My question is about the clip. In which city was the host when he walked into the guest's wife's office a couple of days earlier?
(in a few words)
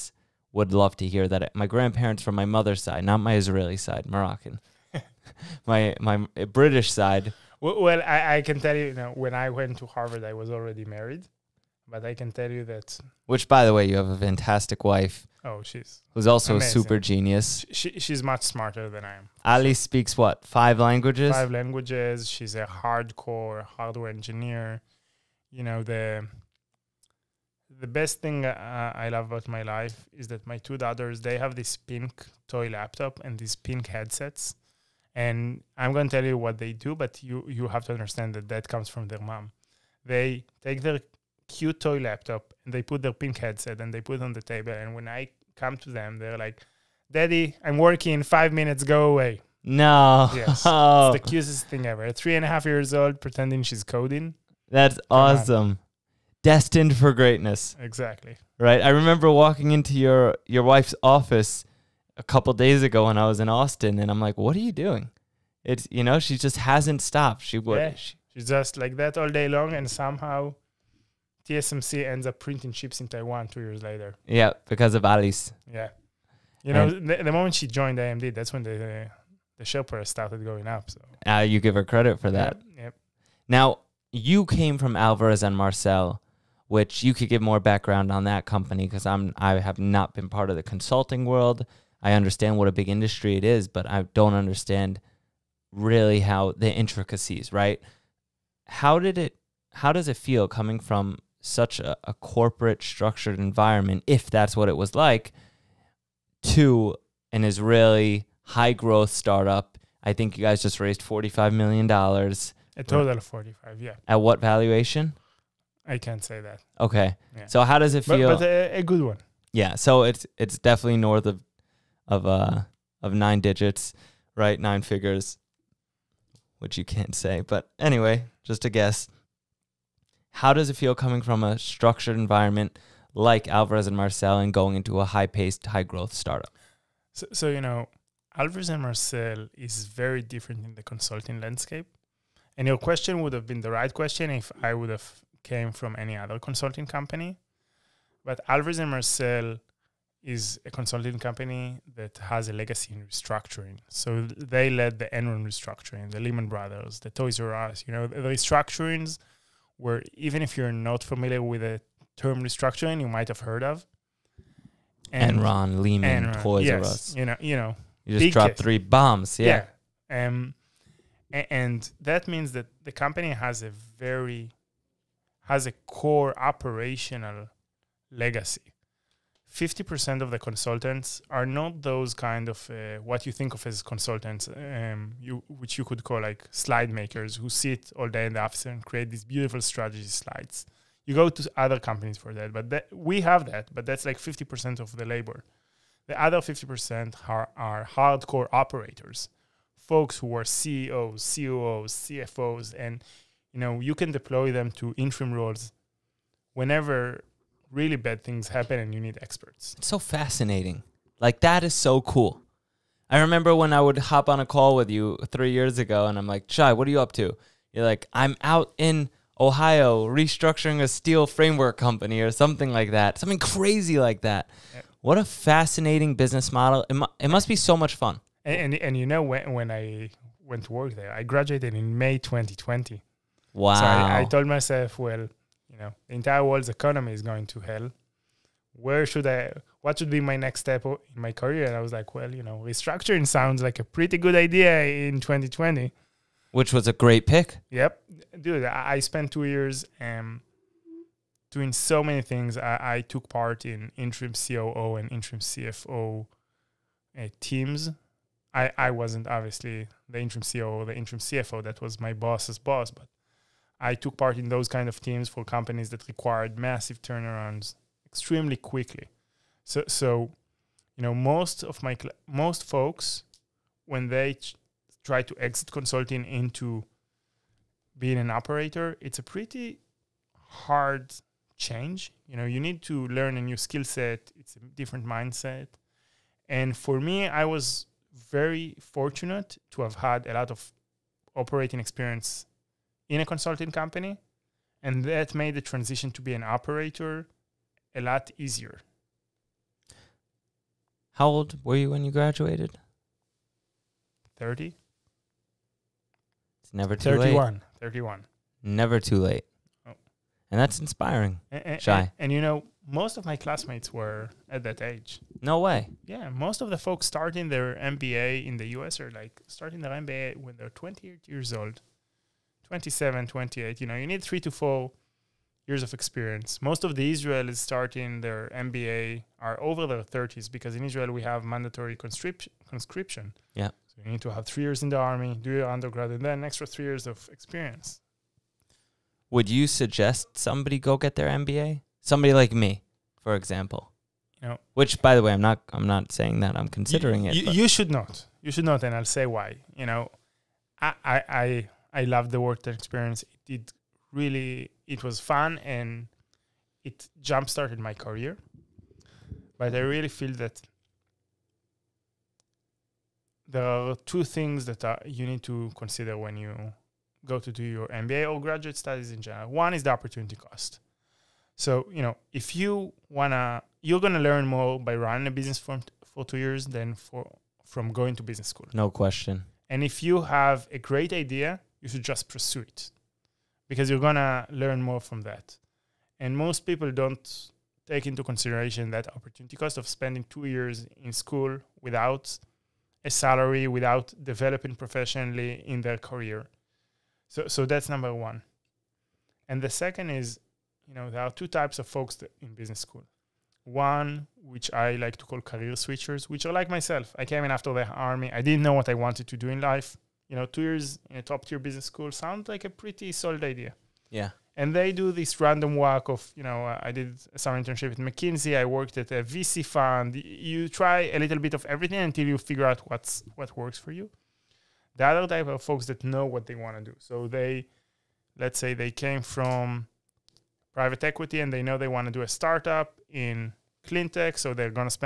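Austin.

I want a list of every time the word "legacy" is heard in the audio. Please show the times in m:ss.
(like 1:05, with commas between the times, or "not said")
2:32, 2:58.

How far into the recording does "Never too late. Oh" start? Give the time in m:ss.
5:08.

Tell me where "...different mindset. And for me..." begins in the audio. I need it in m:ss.
4:44.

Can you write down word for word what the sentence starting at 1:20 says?
So uh, you give her credit for that.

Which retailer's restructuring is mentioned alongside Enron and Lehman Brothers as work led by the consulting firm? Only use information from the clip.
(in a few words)
Toys R Us.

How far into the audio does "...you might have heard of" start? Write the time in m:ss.
2:43.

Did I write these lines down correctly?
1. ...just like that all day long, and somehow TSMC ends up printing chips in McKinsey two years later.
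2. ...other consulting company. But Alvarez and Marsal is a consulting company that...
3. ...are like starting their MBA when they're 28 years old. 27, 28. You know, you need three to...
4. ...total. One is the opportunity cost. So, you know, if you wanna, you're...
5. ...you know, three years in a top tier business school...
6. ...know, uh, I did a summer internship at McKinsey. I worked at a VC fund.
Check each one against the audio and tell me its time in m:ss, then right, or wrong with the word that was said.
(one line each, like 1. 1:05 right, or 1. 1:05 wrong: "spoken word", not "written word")
1. 1:08 wrong: "Taiwan", not "McKinsey"
2. 2:26 right
3. 5:18 right
4. 6:09 wrong: "general", not "total"
5. 6:50 wrong: "two", not "three"
6. 6:56 right.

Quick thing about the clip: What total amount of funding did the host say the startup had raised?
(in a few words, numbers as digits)
$45 million.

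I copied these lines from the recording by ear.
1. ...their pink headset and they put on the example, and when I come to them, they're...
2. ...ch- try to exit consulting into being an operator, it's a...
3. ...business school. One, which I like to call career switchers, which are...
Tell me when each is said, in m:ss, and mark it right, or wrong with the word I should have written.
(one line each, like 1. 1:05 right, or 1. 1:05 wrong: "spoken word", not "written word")
1. 0:43 wrong: "table", not "example"
2. 4:34 right
3. 6:42 right.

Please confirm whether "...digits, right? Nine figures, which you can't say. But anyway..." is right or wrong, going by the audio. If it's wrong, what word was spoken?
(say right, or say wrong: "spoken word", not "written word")
right.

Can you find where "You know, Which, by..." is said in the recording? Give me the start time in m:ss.
5:44.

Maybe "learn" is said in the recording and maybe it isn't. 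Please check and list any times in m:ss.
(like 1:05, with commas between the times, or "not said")
4:43, 6:14, 6:24.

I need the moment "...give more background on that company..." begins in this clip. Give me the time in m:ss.
1:27.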